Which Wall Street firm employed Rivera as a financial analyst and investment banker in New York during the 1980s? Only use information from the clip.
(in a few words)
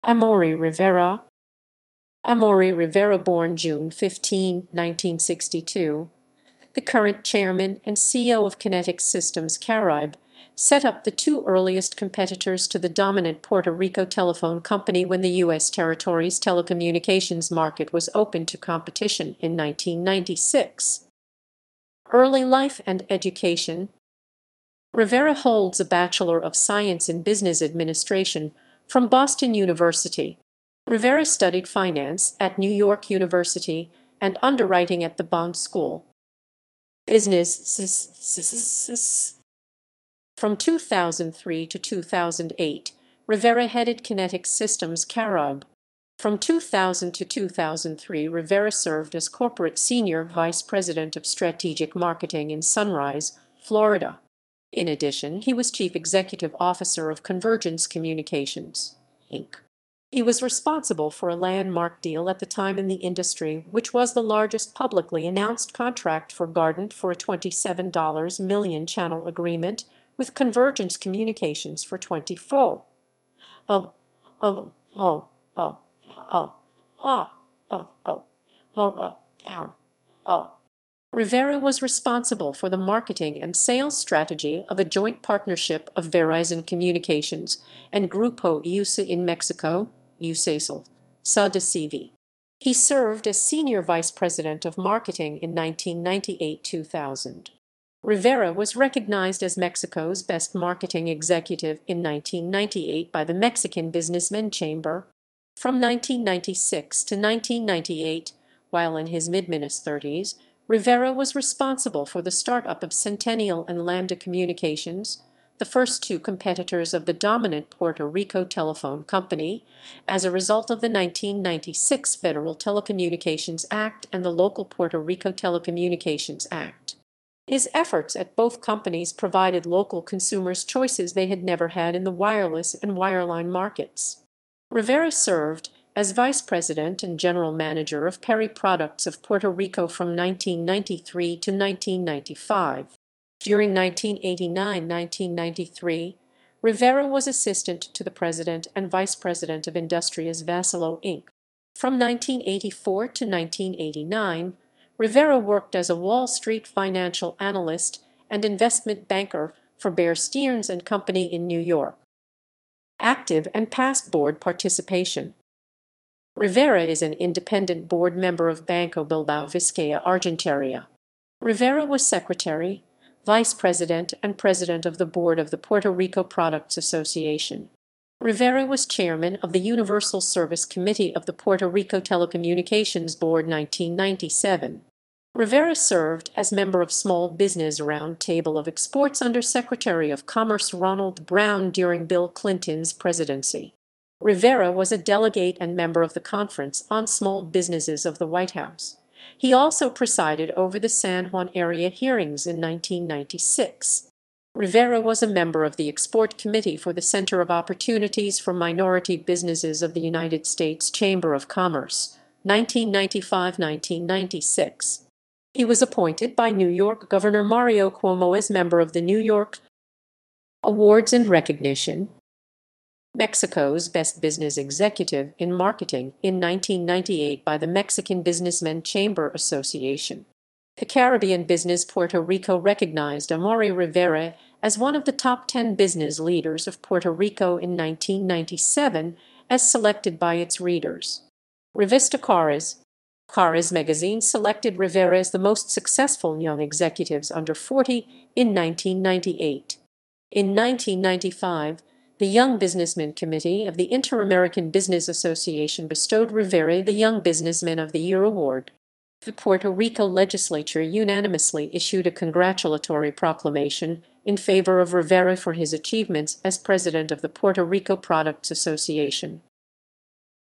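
Bear Stearns.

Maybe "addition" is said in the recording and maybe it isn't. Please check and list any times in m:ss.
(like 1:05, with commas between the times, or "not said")
0:54.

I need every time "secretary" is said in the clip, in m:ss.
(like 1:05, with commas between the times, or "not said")
2:52, 3:09.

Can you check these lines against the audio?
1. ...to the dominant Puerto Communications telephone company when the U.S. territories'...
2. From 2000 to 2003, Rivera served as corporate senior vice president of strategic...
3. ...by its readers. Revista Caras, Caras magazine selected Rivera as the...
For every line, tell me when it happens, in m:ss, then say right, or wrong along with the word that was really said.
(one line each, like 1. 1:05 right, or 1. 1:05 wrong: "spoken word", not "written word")
1. 0:12 wrong: "Rico", not "Communications"
2. 0:46 right
3. 4:00 right.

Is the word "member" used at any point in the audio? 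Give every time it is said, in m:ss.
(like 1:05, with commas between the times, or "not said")
2:48, 3:06, 3:15, 3:25, 3:38.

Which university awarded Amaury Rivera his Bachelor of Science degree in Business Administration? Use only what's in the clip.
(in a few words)
Boston University.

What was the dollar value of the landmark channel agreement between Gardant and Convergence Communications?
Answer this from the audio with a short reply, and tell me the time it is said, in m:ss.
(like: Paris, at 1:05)
$27 million, at 1:07.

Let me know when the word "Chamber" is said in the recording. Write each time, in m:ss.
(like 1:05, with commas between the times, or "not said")
1:44, 3:30, 3:48.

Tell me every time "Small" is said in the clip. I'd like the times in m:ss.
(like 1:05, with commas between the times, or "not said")
3:06, 3:17.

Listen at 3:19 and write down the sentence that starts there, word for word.
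He also presided over the San Juan area hearings in 1996.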